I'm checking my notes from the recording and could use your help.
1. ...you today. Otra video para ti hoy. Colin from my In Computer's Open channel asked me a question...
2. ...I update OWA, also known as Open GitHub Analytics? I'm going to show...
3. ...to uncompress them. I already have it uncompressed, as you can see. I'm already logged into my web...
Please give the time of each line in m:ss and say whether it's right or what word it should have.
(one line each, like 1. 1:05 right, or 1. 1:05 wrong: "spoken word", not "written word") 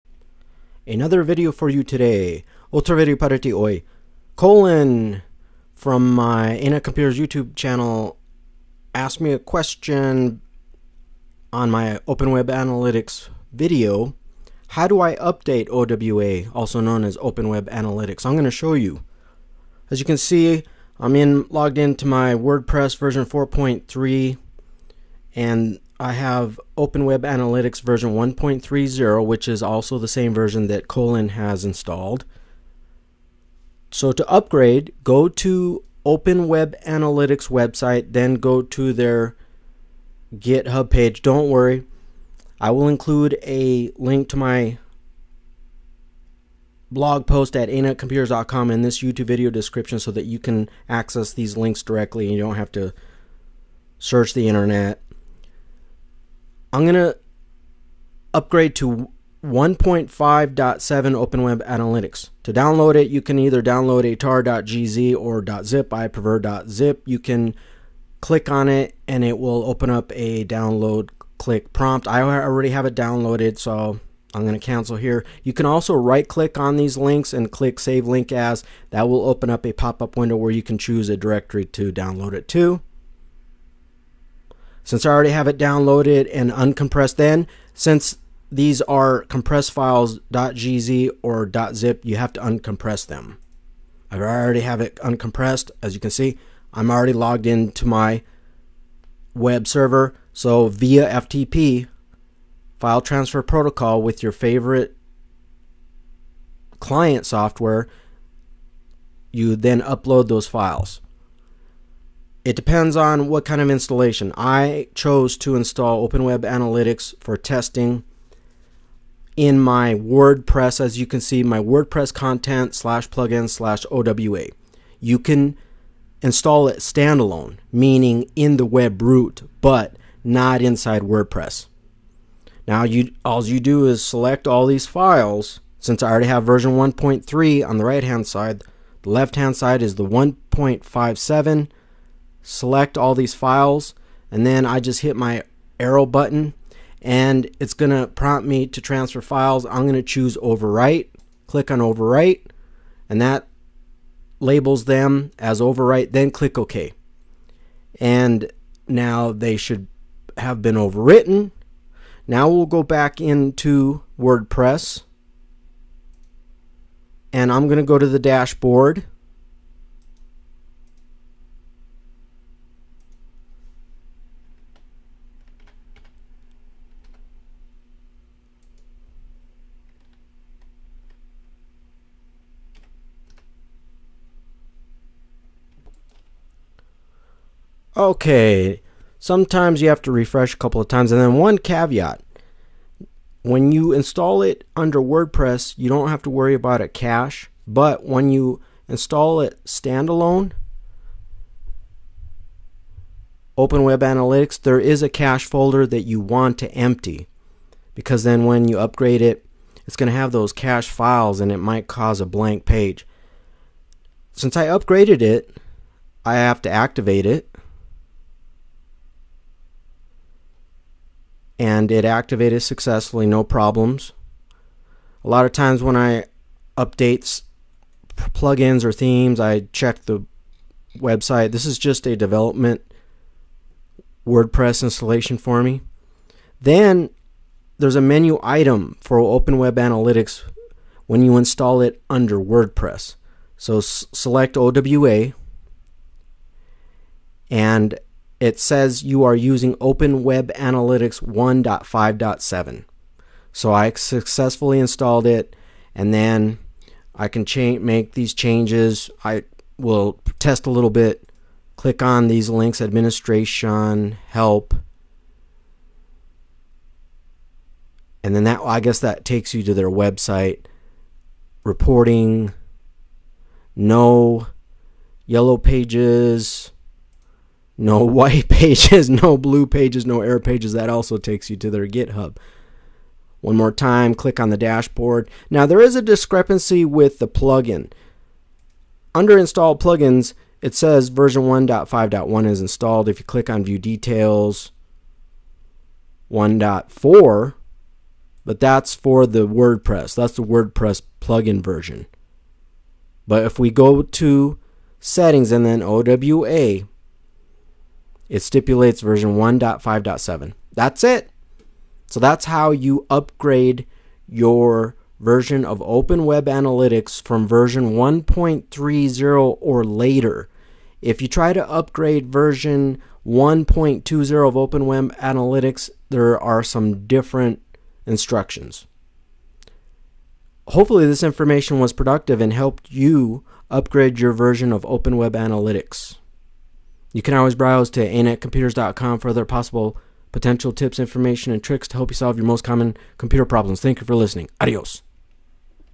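1. 0:01 wrong: "YouTube", not "Open"
2. 0:15 wrong: "Web", not "GitHub"
3. 1:32 right.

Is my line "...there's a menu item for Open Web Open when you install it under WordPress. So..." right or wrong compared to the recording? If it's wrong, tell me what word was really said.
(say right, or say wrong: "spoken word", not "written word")
wrong: "Analytics", not "Open".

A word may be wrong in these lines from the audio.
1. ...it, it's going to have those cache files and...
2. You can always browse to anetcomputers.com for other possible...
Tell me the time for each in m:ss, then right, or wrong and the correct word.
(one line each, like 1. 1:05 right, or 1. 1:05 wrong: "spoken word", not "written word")
1. 3:29 right
2. 5:37 right.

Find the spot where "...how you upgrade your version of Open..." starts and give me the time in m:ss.
5:12.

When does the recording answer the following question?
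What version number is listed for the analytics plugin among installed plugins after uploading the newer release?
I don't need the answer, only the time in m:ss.
4:51.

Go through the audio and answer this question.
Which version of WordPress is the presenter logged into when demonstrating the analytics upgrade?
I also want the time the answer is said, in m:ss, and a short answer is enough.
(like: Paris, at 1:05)
4.3, at 0:22.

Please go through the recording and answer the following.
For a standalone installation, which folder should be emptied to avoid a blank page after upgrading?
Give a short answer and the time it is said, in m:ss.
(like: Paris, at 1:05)
cache folder, at 3:25.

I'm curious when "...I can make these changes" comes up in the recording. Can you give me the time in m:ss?
4:17.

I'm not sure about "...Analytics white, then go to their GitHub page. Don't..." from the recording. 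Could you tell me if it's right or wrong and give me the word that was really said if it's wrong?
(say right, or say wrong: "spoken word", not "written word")
wrong: "website", not "white".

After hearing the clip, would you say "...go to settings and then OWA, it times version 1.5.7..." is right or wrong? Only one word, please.
wrong.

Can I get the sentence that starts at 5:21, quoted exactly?
If you try to upgrade version 1.20 of Open Web Analytics, there are some different instructions.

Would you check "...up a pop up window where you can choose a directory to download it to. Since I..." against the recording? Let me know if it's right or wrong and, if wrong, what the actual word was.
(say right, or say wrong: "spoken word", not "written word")
right.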